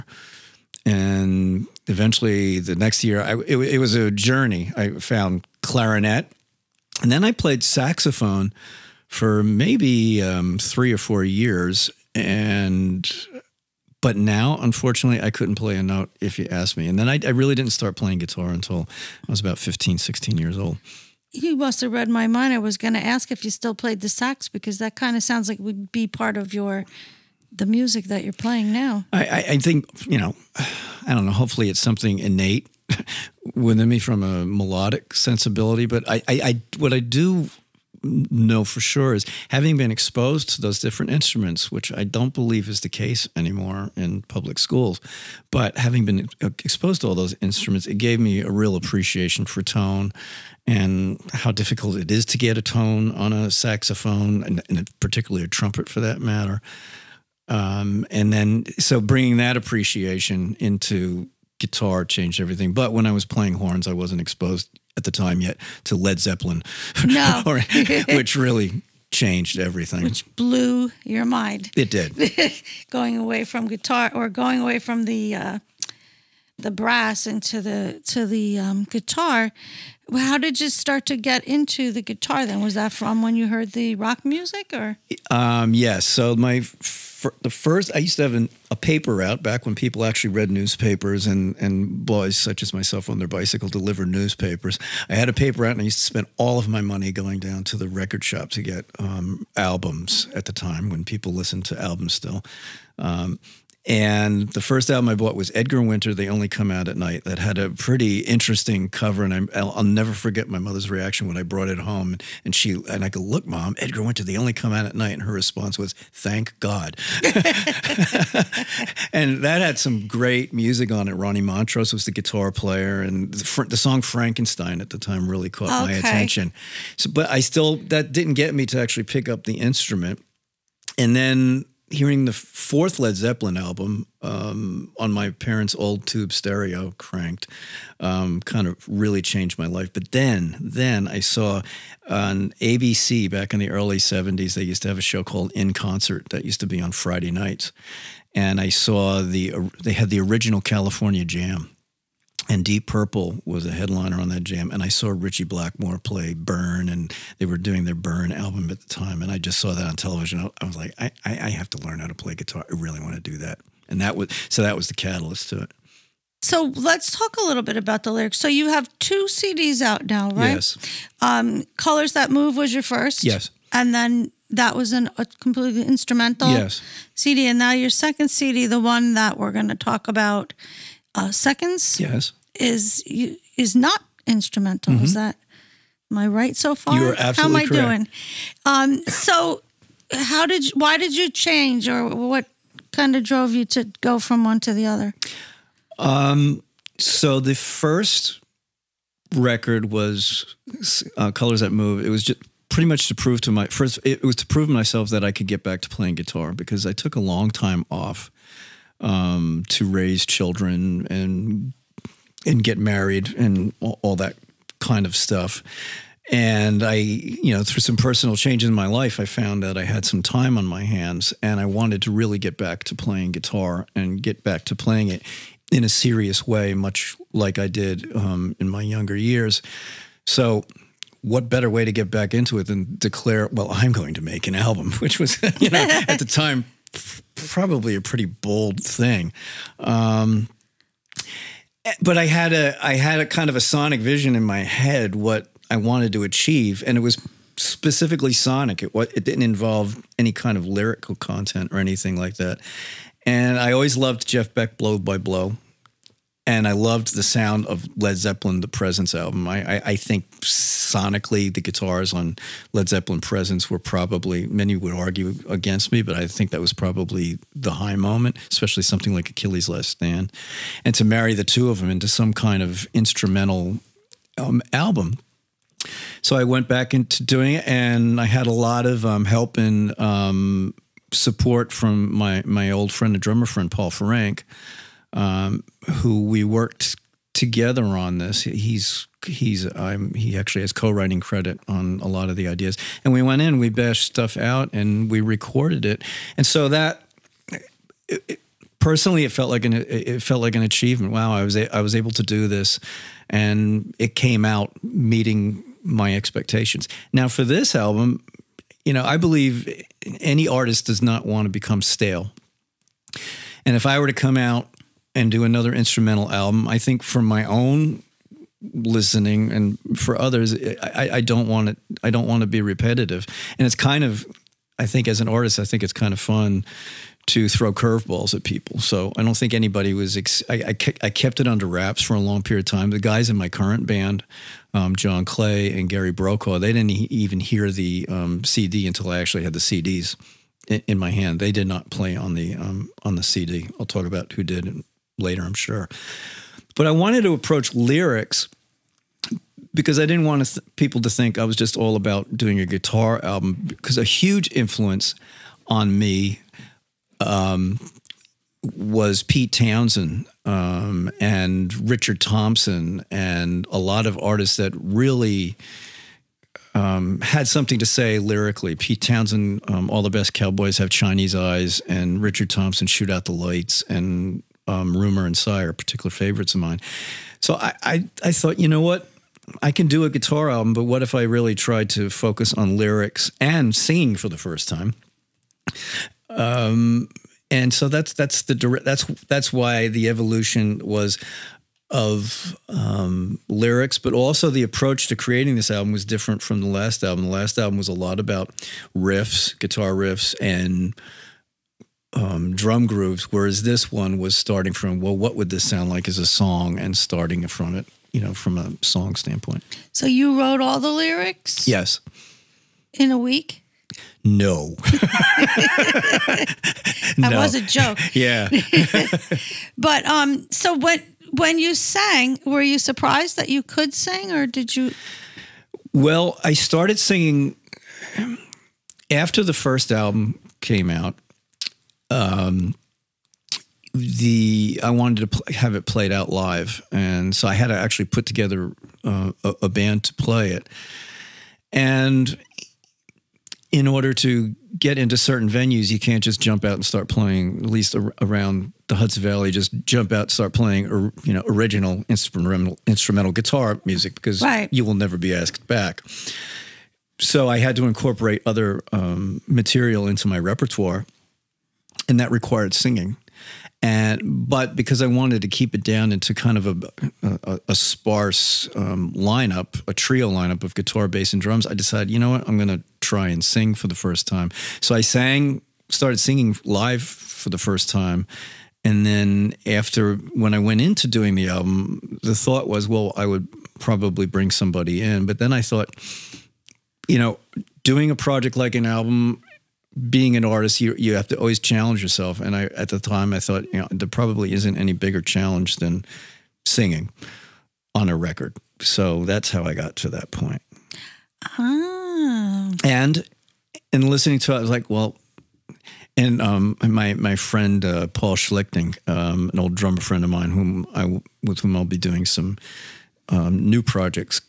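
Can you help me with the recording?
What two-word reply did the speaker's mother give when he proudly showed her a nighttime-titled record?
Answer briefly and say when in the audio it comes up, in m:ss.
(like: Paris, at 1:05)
Thank God, at 1:55.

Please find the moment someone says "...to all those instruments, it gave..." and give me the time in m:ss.
0:47.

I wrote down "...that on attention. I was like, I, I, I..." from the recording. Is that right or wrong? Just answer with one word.
wrong.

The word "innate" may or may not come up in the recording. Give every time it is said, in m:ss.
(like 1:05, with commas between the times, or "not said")
0:32.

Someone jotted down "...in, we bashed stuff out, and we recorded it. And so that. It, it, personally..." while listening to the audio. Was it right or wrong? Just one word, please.
right.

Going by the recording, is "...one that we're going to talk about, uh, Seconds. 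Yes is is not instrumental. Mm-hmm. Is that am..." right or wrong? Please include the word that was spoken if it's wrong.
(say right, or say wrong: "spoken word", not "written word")
right.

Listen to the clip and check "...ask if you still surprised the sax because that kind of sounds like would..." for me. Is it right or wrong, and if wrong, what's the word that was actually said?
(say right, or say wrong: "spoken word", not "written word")
wrong: "played", not "surprised".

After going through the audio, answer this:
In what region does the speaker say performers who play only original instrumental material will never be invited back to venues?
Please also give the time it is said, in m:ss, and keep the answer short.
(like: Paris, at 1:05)
Hudson Valley, at 7:28.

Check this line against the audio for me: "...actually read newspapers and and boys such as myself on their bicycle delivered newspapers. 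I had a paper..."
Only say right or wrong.
right.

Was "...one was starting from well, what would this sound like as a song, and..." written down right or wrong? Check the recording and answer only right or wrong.
right.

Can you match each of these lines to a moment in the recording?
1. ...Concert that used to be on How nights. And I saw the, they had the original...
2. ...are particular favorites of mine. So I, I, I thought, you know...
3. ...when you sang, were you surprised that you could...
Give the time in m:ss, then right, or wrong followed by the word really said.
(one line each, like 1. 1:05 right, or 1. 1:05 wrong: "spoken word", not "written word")
1. 2:25 wrong: "Friday", not "How"
2. 6:15 right
3. 7:01 right.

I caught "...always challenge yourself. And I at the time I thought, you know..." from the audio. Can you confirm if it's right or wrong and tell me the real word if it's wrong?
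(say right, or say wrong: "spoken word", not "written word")
right.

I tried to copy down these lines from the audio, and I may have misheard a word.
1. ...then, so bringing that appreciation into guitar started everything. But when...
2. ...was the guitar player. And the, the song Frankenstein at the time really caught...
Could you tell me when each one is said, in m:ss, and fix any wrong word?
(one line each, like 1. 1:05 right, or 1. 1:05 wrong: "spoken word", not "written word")
1. 0:58 wrong: "changed", not "started"
2. 2:01 right.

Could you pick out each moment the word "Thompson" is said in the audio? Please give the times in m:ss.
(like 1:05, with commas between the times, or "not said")
6:02, 6:12.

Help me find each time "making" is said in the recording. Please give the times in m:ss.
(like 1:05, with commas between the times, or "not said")
not said.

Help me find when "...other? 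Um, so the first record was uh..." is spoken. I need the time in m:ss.
3:14.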